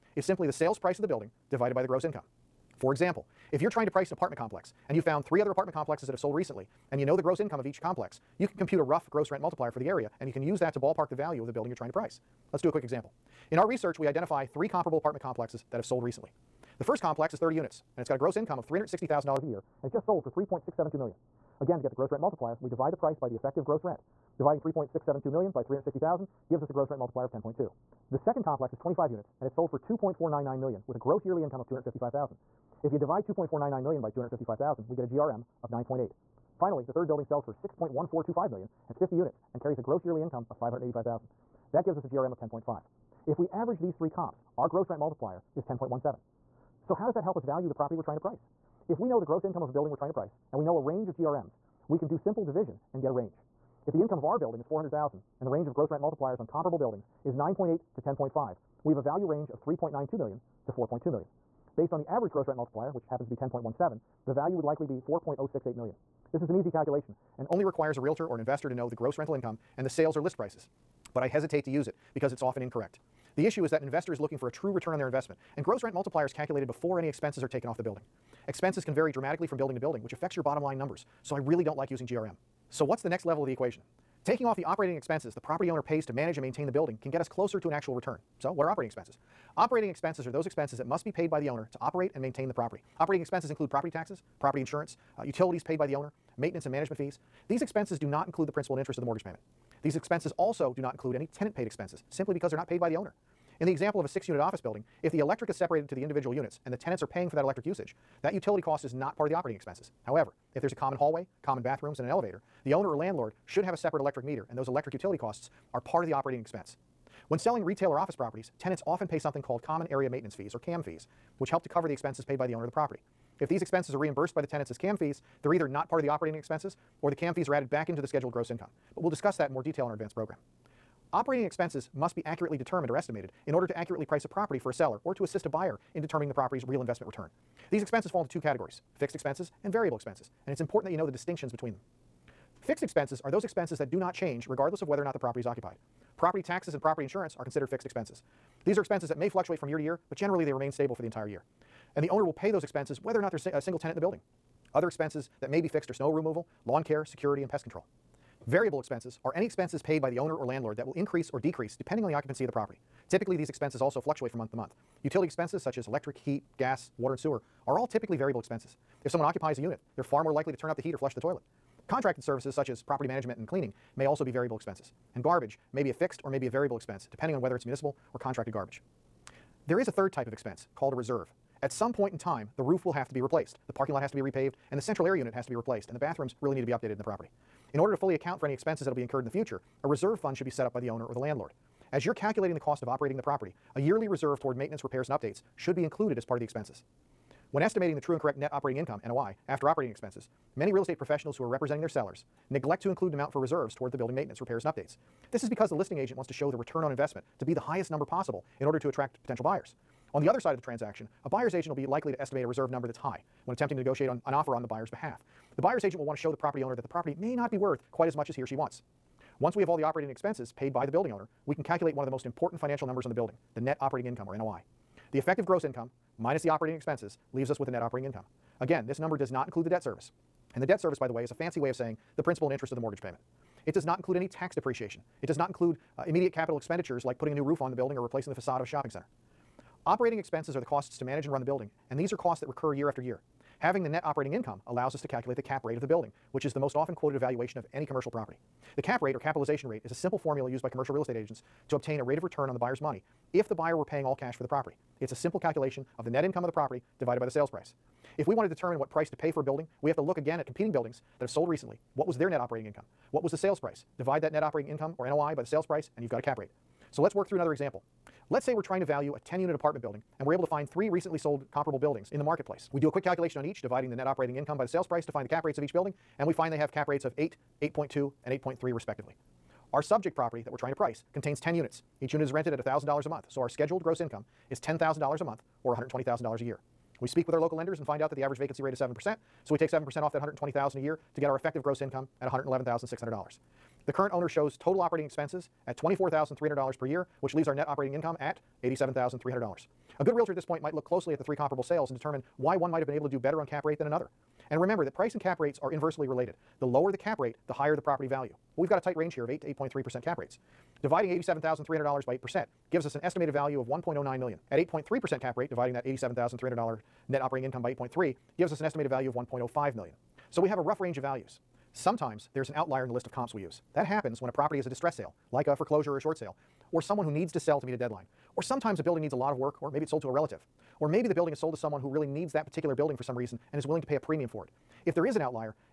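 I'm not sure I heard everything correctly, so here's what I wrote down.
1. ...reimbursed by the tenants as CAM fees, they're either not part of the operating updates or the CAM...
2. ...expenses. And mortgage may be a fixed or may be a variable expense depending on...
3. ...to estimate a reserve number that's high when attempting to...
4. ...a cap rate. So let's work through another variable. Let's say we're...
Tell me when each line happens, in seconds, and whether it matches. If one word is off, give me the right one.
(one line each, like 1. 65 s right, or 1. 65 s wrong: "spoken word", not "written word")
1. 123 s wrong: "expenses", not "updates"
2. 174 s wrong: "garbage", not "mortgage"
3. 212 s right
4. 266 s wrong: "example", not "variable".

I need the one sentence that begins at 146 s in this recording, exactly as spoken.
Property taxes and property insurance are considered fixed expenses.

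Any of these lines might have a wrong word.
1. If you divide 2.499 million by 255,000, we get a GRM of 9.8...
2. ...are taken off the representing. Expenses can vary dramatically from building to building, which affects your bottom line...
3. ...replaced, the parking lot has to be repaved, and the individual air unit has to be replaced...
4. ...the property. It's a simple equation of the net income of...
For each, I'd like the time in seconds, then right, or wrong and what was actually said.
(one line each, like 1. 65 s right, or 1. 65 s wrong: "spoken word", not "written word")
1. 32 s right
2. 77 s wrong: "building", not "representing"
3. 183 s wrong: "central", not "individual"
4. 254 s wrong: "calculation", not "equation".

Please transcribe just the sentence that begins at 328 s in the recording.
Or sometimes a building needs a lot of work, or maybe it's sold to a relative.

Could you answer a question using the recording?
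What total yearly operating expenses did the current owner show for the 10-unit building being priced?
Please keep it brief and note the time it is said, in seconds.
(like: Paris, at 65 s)
$24,300, at 295 s.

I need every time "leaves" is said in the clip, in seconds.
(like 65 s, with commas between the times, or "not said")
227 s, 297 s.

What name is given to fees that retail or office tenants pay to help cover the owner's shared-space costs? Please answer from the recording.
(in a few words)
Common Area Maintenance Fees.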